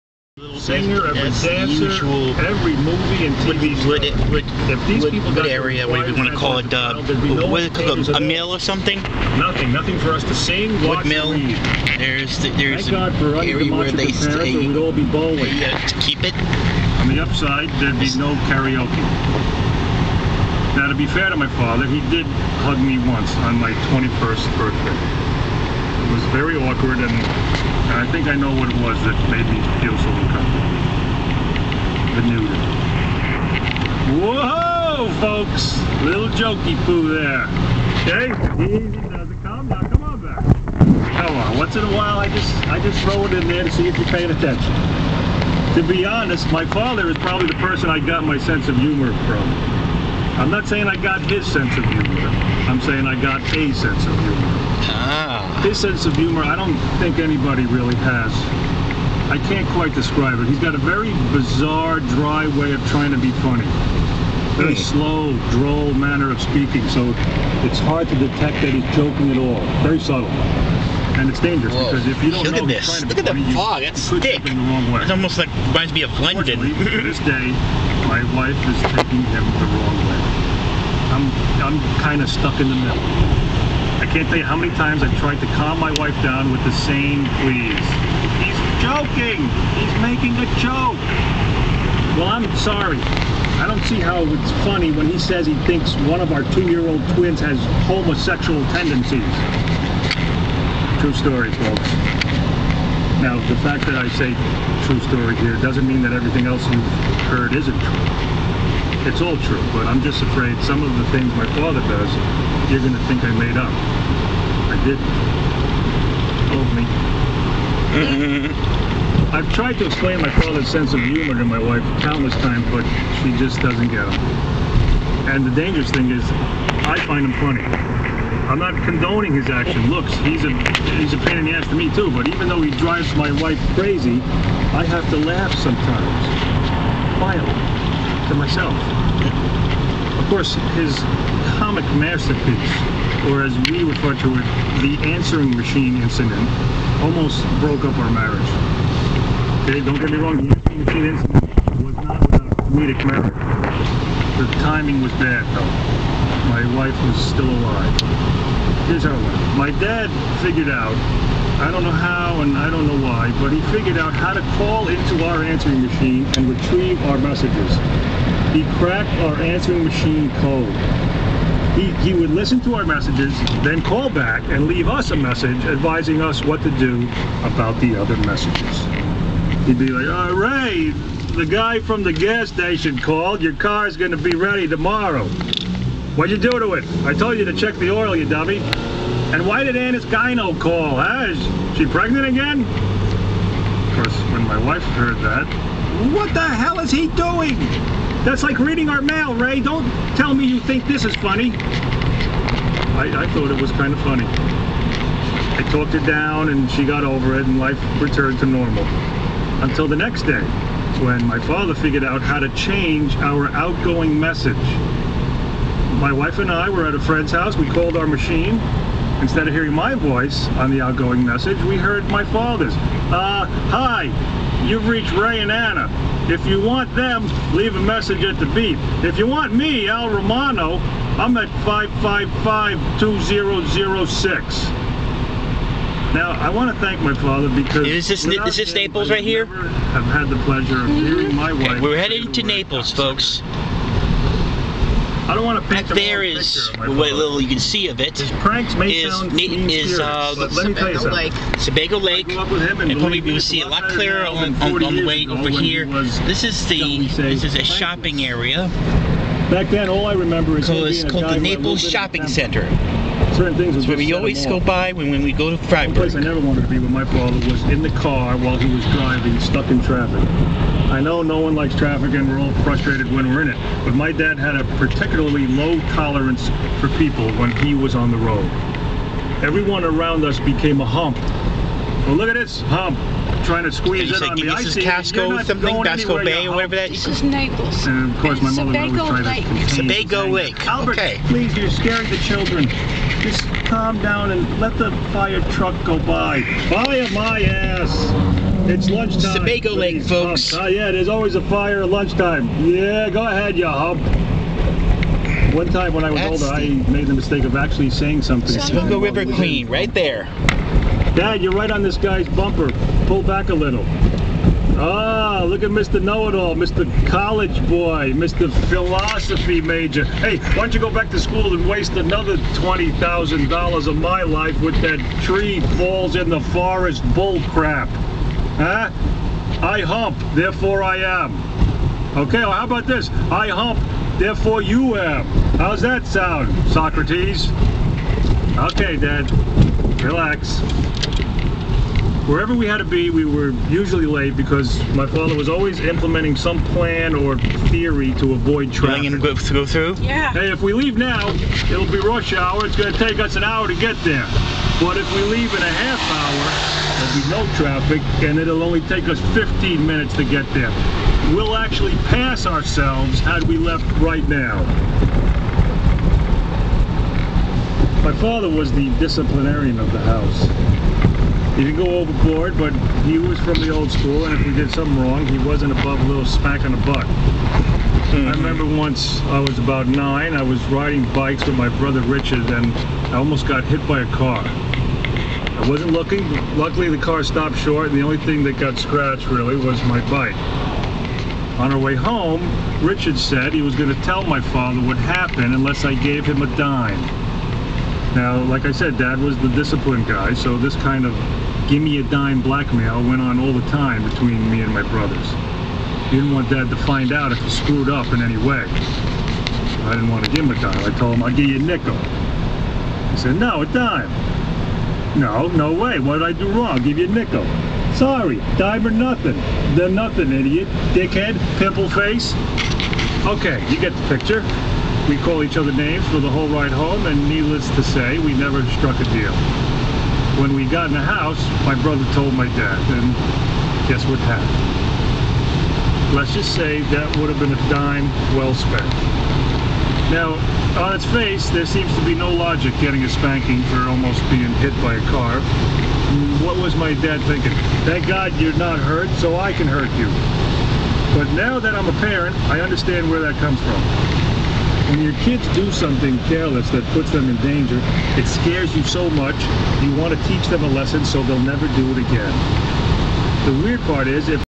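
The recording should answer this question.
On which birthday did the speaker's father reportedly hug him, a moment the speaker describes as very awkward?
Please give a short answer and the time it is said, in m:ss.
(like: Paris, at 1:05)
21st, at 0:23.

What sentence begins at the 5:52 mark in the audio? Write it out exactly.
It's going to take us an hour to get there.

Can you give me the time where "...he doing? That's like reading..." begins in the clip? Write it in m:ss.
3:16.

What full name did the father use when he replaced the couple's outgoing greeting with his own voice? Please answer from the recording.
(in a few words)
Al Romano.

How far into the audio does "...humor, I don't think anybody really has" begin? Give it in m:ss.
0:56.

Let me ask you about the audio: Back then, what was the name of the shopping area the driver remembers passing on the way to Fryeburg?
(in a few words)
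Naples Shopping Center.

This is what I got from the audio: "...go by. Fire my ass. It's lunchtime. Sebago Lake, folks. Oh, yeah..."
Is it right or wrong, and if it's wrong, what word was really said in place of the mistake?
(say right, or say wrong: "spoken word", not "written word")
right.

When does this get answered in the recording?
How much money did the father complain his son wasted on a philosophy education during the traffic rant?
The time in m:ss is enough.
5:22.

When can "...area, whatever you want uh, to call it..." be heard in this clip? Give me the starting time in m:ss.
0:05.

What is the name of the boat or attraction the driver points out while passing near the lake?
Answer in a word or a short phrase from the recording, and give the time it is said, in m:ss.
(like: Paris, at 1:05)
Sebago River Queen, at 5:08.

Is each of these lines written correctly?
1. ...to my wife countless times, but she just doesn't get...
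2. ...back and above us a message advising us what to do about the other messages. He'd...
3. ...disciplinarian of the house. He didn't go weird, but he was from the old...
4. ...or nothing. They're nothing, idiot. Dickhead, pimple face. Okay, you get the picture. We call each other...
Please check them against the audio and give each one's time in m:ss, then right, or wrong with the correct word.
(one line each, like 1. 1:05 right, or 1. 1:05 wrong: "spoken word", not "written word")
1. 2:01 right
2. 2:54 wrong: "leave", not "above"
3. 6:08 wrong: "overboard", not "weird"
4. 6:58 right.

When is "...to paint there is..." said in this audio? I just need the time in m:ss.
4:05.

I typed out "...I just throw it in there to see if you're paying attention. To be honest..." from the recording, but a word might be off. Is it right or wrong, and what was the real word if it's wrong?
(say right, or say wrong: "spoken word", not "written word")
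right.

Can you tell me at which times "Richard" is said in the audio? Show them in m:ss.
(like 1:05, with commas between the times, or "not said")
6:22, 6:32.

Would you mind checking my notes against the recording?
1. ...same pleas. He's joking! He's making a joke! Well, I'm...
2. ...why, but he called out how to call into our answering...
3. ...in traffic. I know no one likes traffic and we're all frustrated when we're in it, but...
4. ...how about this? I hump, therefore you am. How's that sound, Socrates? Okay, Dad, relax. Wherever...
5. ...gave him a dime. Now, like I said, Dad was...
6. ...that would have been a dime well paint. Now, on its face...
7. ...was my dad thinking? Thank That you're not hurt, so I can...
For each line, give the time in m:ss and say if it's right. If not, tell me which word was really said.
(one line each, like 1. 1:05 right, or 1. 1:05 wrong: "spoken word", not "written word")
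1. 1:26 right
2. 2:43 wrong: "figured", not "called"
3. 4:29 right
4. 5:32 right
5. 6:35 right
6. 7:16 wrong: "spent", not "paint"
7. 7:26 wrong: "God", not "That".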